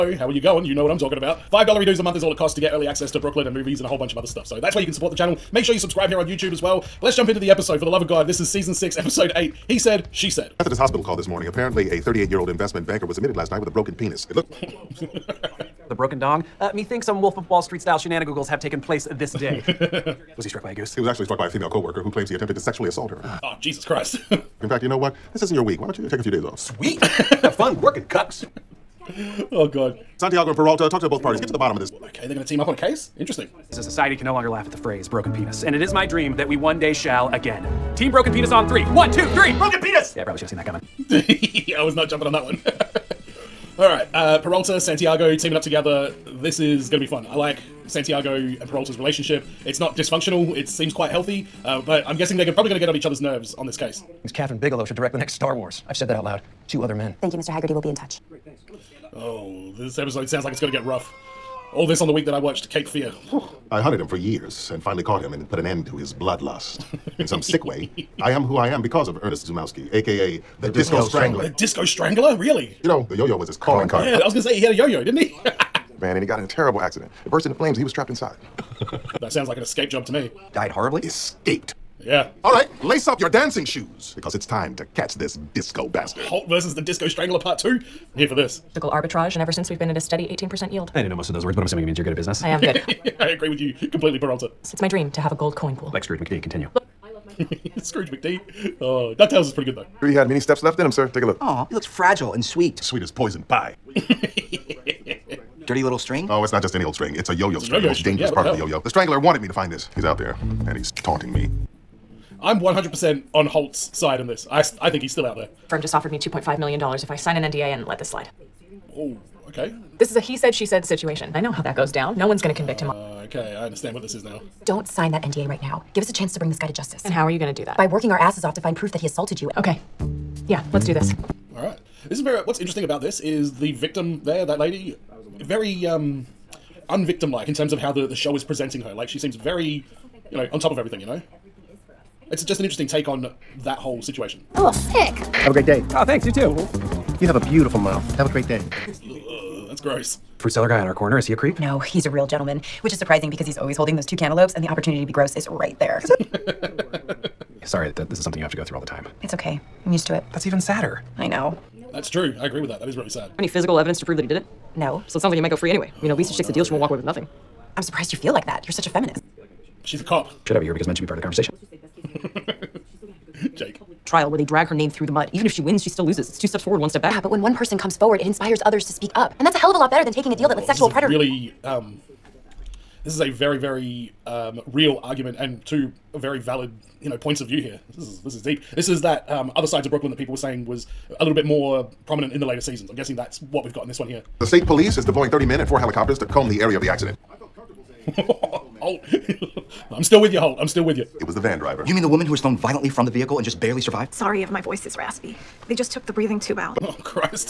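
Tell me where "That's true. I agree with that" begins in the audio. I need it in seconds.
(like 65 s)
161 s.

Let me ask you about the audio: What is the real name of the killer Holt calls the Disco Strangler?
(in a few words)
Ernest Zumowski.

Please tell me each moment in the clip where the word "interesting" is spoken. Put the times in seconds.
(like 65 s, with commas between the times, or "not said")
33 s, 132 s, 142 s.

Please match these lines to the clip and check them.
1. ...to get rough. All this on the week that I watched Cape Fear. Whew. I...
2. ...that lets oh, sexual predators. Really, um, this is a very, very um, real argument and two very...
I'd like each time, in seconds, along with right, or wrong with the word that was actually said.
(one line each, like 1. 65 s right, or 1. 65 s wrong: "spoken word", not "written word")
1. 60 s right
2. 180 s right.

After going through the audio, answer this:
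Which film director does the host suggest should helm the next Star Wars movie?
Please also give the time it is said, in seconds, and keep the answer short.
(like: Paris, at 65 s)
Kathryn Bigelow, at 54 s.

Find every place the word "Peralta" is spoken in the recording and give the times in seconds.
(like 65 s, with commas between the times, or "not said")
30 s, 44 s, 48 s, 94 s.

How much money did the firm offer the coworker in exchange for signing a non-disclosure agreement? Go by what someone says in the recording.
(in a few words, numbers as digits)
$2.5 million.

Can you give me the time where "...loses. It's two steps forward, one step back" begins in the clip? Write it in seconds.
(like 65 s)
176 s.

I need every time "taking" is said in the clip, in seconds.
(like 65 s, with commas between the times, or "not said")
180 s.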